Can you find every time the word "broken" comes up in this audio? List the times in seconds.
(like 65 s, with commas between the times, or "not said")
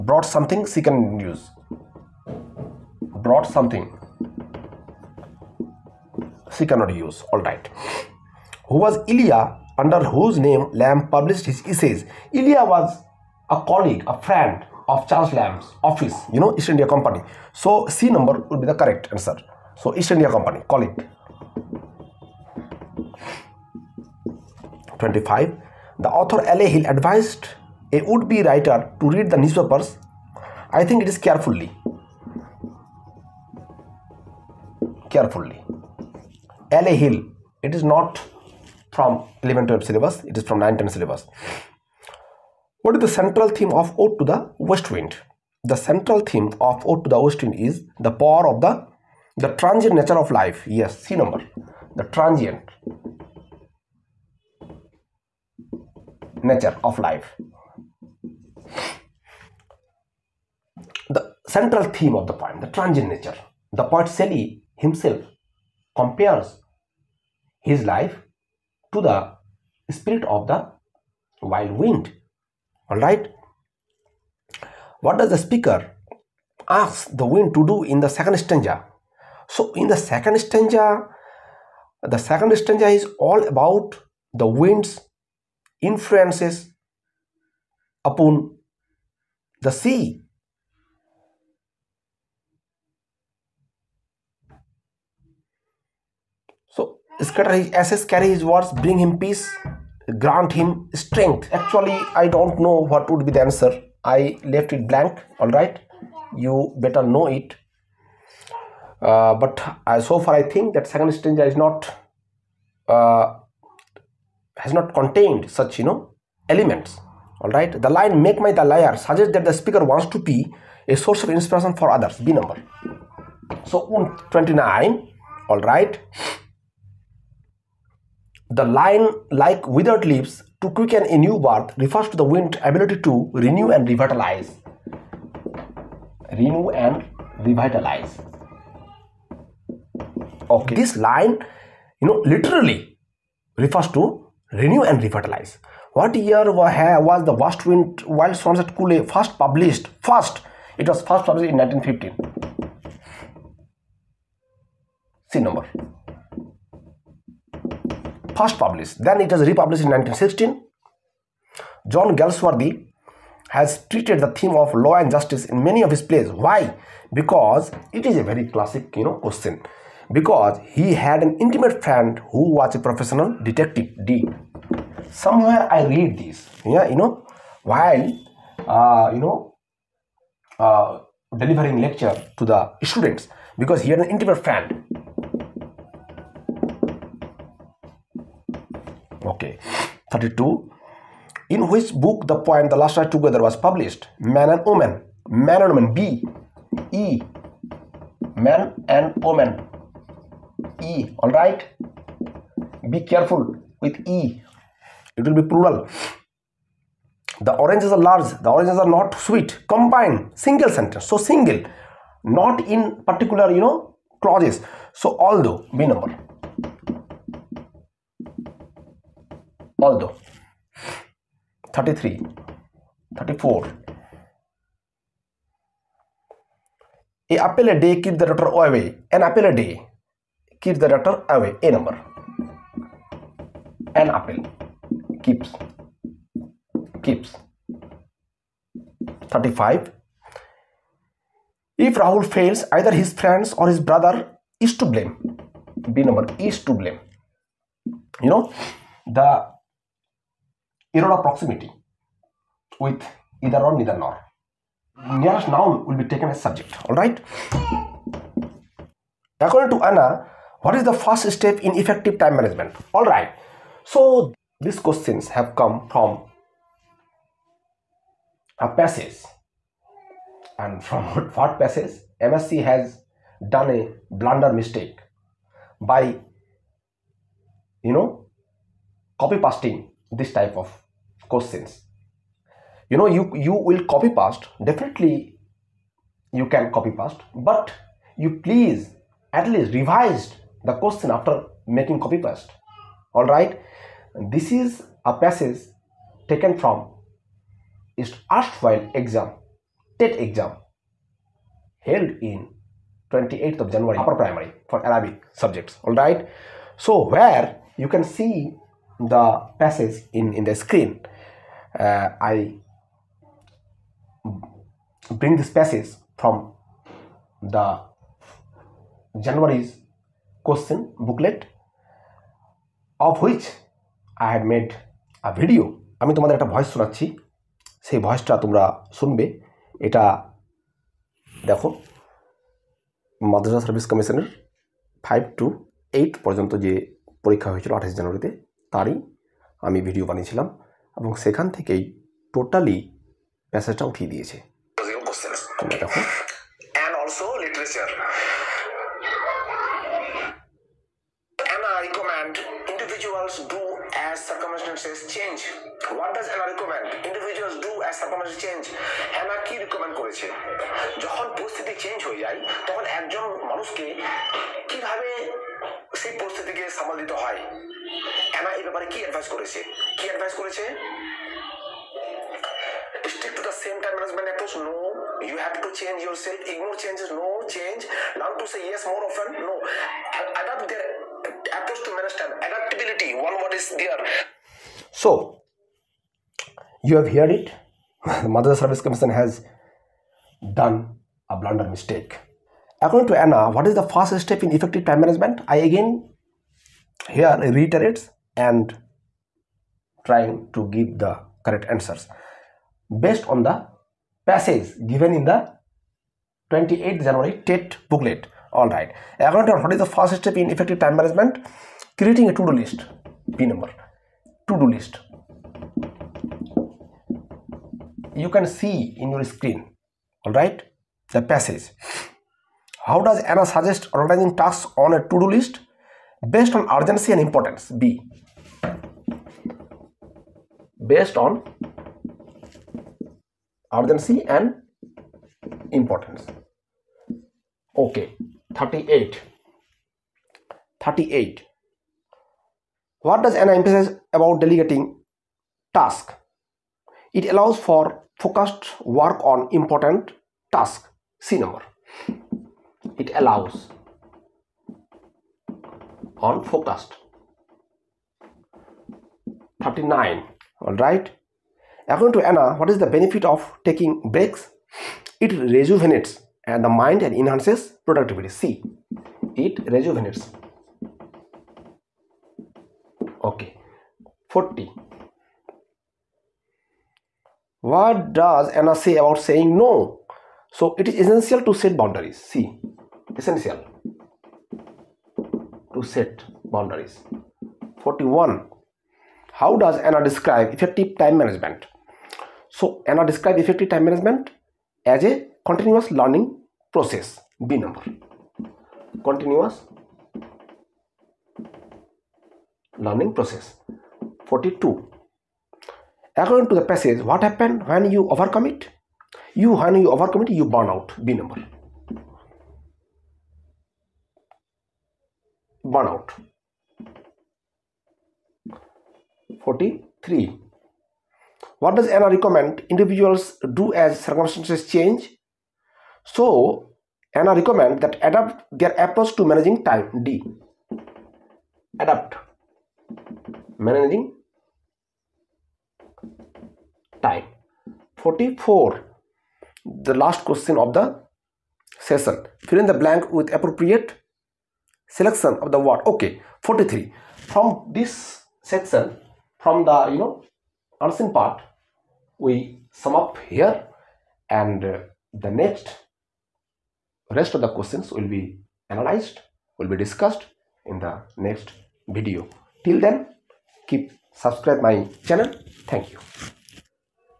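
not said.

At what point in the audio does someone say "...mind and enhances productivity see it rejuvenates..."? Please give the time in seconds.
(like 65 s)
466 s.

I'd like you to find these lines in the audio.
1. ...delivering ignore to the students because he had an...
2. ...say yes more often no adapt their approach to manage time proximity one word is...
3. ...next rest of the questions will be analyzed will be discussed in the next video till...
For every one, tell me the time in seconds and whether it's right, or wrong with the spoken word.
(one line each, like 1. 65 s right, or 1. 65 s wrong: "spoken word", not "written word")
1. 181 s wrong: "lecture", not "ignore"
2. 378 s wrong: "adaptability", not "proximity"
3. 555 s right.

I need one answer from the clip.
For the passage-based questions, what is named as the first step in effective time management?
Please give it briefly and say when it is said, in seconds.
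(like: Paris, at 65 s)
Creating a to-do list, at 411 s.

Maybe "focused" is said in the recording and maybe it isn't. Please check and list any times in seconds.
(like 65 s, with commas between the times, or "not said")
448 s, 456 s.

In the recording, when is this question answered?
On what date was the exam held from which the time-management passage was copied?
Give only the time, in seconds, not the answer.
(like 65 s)
303 s.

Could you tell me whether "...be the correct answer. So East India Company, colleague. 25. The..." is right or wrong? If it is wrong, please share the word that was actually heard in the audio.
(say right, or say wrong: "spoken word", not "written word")
right.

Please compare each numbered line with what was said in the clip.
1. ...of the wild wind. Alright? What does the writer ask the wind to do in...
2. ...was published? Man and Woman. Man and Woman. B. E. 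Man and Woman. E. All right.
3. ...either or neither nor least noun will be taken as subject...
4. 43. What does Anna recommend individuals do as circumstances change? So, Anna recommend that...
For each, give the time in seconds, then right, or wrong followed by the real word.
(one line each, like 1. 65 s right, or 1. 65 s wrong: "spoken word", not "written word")
1. 70 s wrong: "speaker", not "writer"
2. 193 s right
3. 253 s wrong: "nearest", not "least"
4. 519 s right.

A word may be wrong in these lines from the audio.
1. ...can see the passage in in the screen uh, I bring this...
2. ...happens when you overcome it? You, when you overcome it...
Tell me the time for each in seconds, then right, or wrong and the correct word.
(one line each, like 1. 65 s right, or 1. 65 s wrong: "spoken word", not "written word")
1. 307 s right
2. 507 s right.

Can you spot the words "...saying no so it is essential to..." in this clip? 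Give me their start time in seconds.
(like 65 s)
479 s.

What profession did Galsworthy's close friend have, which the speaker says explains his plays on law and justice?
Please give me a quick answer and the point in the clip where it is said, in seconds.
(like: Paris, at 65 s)
Professional detective, at 172 s.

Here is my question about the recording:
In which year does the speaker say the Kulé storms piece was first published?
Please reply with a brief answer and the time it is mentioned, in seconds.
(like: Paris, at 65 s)
1915, at 151 s.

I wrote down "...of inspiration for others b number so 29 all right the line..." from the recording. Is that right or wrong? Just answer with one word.
right.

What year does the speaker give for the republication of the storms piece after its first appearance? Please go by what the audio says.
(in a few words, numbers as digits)
1916.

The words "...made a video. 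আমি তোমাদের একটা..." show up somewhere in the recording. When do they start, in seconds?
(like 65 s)
324 s.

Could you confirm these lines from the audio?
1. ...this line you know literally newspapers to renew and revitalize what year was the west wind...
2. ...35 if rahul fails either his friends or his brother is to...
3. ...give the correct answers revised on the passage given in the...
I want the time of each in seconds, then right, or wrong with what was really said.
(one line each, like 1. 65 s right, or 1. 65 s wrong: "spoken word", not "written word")
1. 140 s wrong: "refers", not "newspapers"
2. 239 s right
3. 400 s wrong: "based", not "revised".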